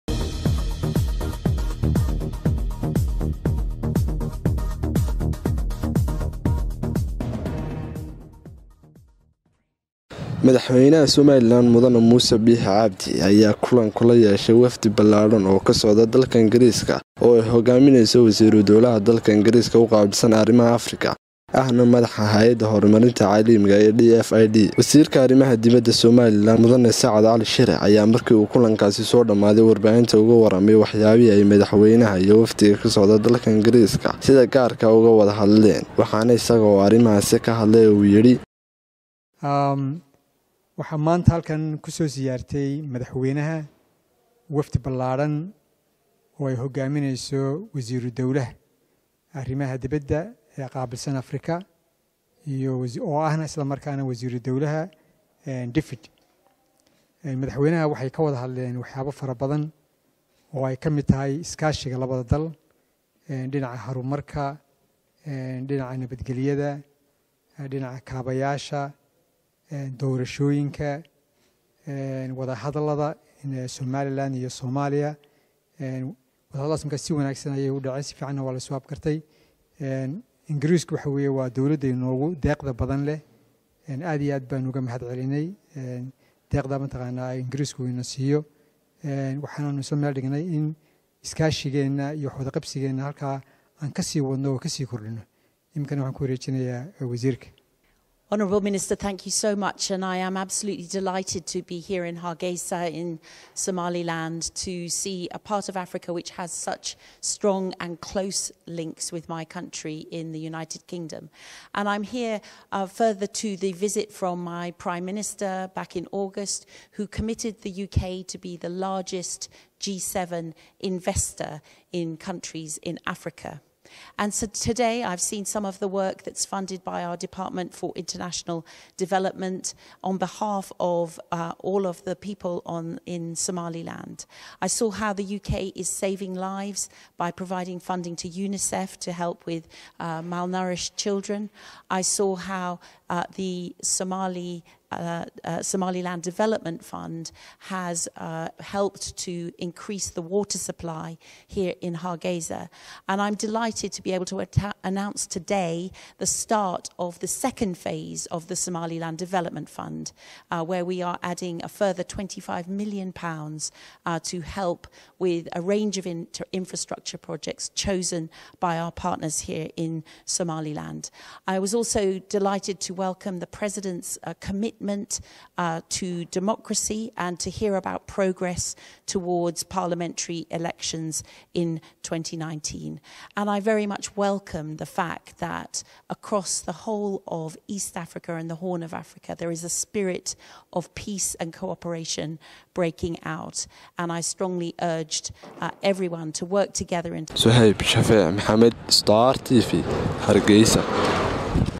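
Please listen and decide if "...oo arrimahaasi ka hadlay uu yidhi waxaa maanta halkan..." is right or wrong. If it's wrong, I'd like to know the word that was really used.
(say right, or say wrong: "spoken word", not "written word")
right.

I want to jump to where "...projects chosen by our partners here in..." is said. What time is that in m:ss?
2:47.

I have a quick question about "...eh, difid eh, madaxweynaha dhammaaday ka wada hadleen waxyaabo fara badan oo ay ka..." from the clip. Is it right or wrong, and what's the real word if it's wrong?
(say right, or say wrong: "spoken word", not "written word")
wrong: "waxay", not "dhammaaday".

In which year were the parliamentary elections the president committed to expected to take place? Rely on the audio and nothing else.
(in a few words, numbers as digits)
2019.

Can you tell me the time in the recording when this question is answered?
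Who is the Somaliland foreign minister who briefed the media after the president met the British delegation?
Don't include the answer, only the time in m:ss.
0:27.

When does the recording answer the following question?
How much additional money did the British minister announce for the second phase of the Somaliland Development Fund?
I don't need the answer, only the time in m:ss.
2:42.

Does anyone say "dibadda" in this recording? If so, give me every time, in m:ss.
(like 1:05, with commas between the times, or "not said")
0:25, 0:49.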